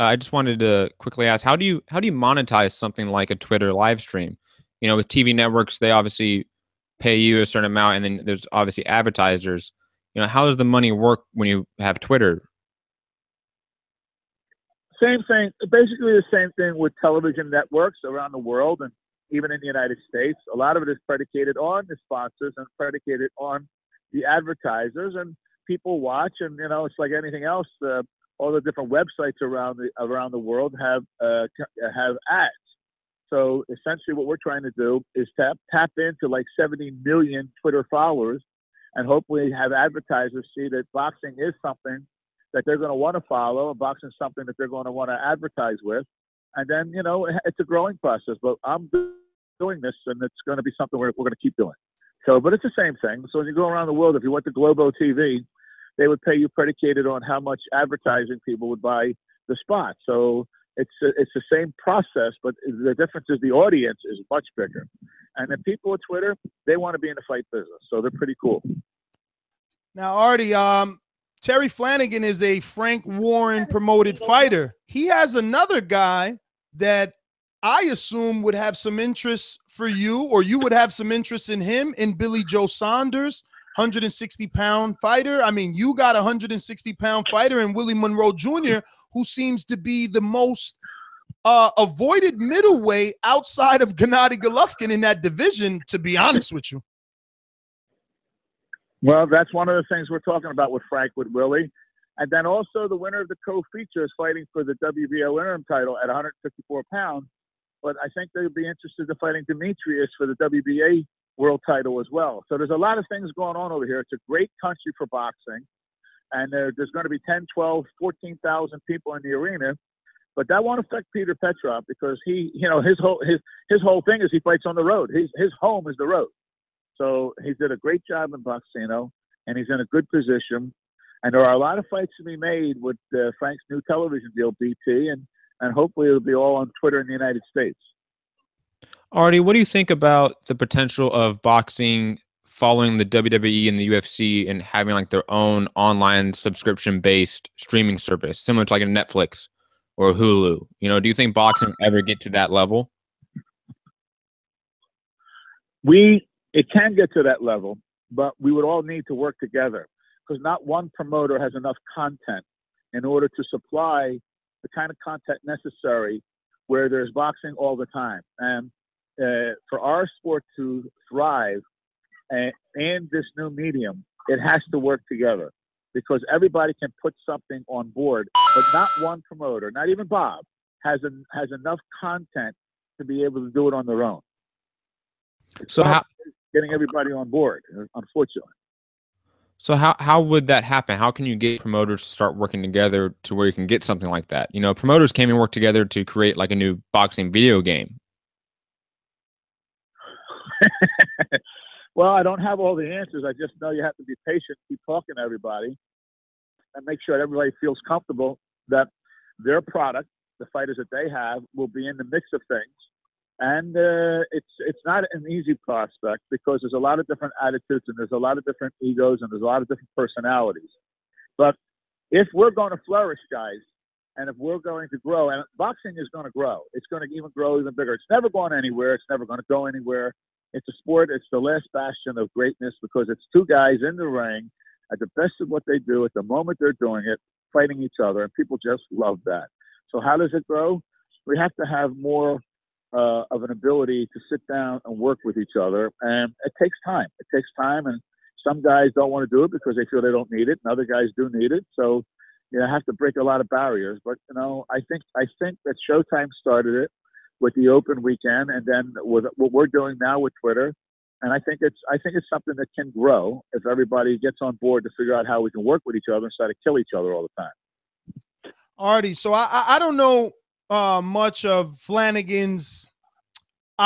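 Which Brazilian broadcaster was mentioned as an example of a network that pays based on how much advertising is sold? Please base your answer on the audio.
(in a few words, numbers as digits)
Globo TV.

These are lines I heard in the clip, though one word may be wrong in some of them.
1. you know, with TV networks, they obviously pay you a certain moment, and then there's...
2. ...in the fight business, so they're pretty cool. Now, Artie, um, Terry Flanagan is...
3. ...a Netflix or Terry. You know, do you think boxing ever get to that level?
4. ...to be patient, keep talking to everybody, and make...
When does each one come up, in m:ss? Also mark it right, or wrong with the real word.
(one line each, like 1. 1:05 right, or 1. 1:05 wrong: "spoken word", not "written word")
1. 0:04 wrong: "amount", not "moment"
2. 1:07 right
3. 2:28 wrong: "Hulu", not "Terry"
4. 3:23 right.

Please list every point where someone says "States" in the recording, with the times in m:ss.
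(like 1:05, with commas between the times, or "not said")
0:20, 2:17.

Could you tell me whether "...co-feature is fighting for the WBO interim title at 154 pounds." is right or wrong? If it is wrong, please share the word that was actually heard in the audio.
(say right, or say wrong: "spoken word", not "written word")
right.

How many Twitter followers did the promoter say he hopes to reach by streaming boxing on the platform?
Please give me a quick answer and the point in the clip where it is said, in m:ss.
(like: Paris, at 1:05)
70 million, at 0:36.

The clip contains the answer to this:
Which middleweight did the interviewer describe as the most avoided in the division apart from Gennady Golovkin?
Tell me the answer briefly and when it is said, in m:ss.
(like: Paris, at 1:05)
Willie Monroe Jr., at 1:27.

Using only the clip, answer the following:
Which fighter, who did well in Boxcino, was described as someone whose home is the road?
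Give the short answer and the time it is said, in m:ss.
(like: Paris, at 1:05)
Peter Petrov, at 2:01.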